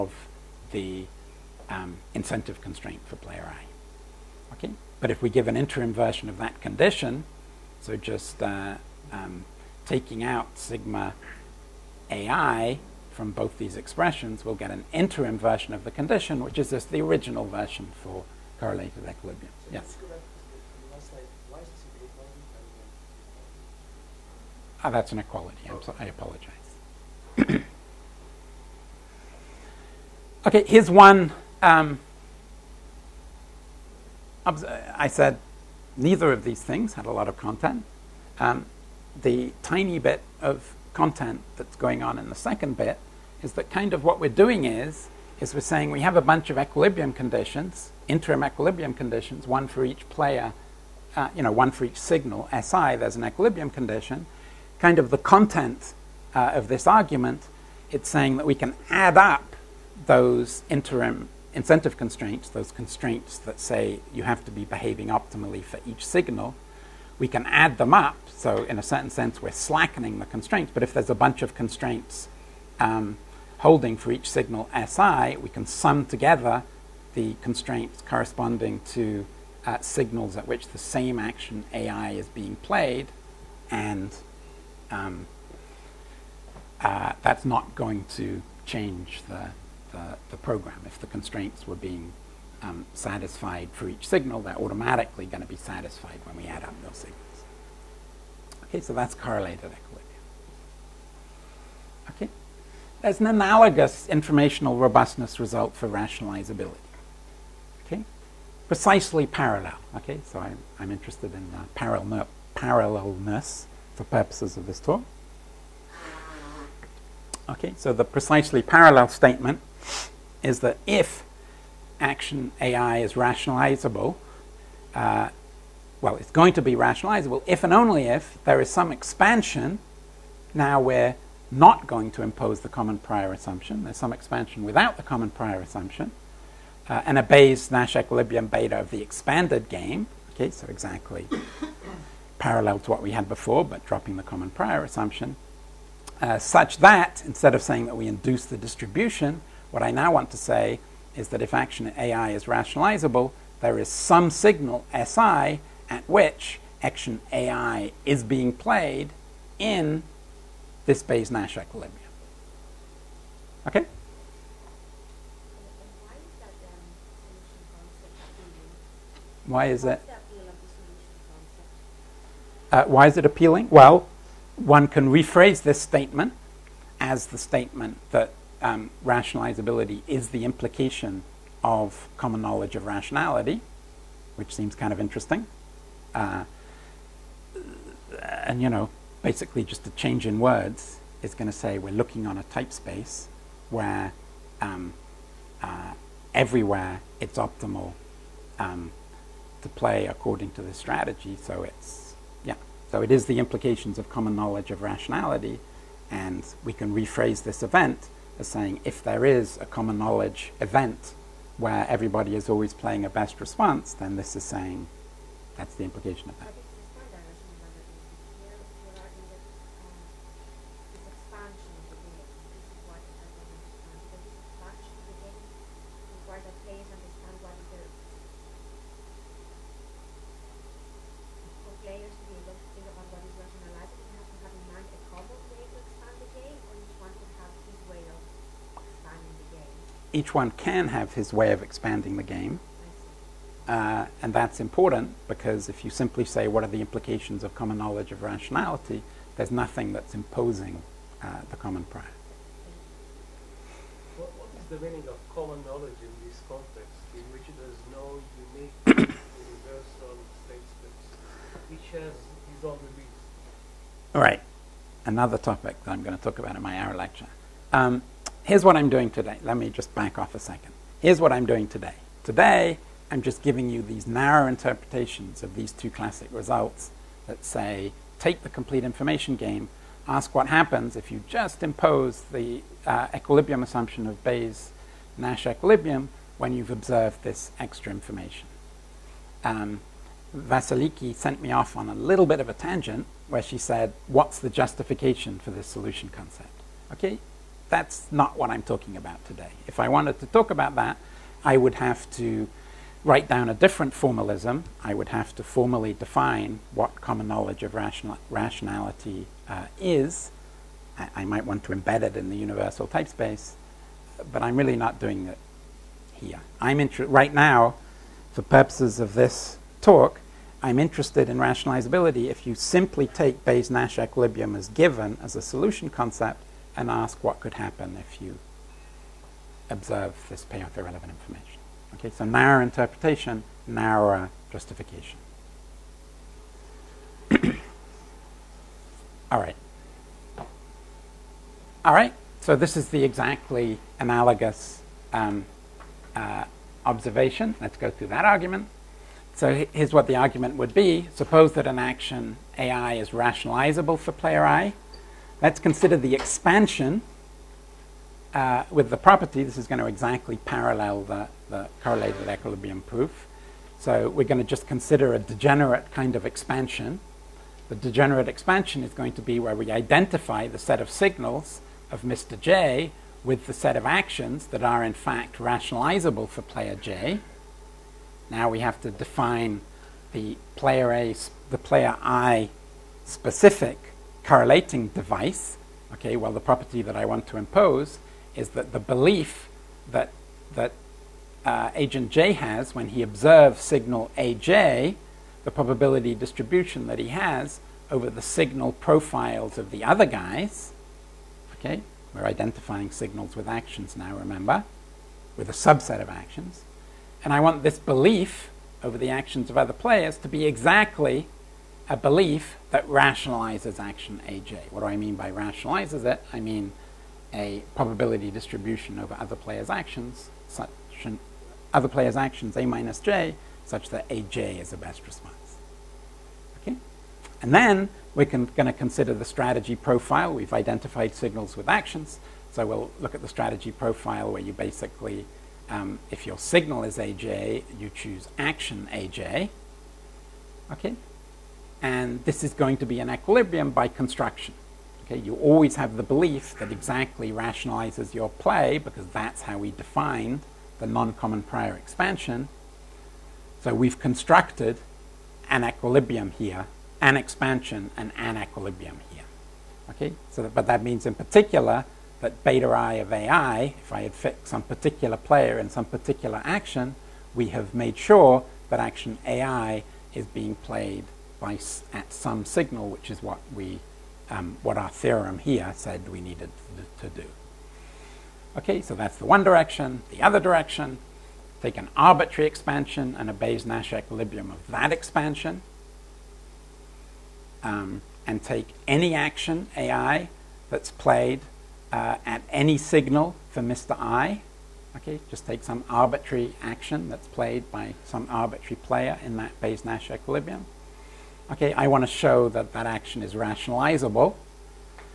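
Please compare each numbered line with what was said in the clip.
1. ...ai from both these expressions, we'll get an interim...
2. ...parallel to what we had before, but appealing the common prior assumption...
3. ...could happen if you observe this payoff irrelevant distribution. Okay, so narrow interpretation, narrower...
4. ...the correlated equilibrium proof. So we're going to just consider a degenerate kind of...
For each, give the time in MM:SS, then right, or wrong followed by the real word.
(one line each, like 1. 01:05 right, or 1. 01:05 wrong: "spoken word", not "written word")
1. 00:12 right
2. 02:22 wrong: "dropping", not "appealing"
3. 05:27 wrong: "information", not "distribution"
4. 06:01 right.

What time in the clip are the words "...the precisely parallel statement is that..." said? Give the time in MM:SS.
01:57.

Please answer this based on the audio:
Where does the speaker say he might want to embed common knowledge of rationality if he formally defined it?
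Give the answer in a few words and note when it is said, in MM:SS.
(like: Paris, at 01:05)
universal type space, at 05:12.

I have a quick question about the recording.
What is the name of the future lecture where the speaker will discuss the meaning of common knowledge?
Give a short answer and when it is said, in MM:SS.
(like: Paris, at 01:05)
Arrow lecture, at 04:26.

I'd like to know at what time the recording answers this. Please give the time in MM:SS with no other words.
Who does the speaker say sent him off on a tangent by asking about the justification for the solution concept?
04:50.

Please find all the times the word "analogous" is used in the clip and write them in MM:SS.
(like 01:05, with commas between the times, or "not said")
01:43, 05:43.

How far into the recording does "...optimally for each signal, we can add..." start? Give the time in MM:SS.
01:05.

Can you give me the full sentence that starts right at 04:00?
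each one can have his way of expanding the game.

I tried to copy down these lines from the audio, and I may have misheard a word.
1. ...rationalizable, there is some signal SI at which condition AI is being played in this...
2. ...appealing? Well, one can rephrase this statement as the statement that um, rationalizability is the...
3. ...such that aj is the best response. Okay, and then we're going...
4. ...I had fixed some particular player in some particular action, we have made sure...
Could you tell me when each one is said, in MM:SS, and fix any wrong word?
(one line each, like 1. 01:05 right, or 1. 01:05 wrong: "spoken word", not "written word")
1. 02:32 wrong: "action", not "condition"
2. 02:53 right
3. 07:03 right
4. 07:43 right.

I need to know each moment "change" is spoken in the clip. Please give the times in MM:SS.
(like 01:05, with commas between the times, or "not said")
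01:28, 03:09.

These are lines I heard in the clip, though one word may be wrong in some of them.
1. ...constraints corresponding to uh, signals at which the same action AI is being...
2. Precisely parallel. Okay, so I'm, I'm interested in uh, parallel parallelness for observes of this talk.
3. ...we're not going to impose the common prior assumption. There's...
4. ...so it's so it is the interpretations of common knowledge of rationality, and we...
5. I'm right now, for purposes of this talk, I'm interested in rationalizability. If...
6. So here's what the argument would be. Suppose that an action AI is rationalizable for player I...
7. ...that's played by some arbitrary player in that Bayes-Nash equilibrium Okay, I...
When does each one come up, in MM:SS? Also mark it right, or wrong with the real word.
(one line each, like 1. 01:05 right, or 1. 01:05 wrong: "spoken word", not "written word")
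1. 01:17 right
2. 01:48 wrong: "purposes", not "observes"
3. 02:10 right
4. 03:21 wrong: "implications", not "interpretations"
5. 05:16 right
6. 05:49 right
7. 08:17 right.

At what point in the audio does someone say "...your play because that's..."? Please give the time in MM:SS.
07:28.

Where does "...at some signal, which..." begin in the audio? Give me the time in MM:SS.
07:51.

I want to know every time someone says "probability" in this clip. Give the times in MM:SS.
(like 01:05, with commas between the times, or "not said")
06:35, 06:57.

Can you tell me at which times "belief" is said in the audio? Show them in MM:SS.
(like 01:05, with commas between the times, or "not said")
06:28, 06:47, 06:51, 07:26.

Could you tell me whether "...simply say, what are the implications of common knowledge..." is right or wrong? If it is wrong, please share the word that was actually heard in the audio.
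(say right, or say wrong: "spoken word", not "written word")
right.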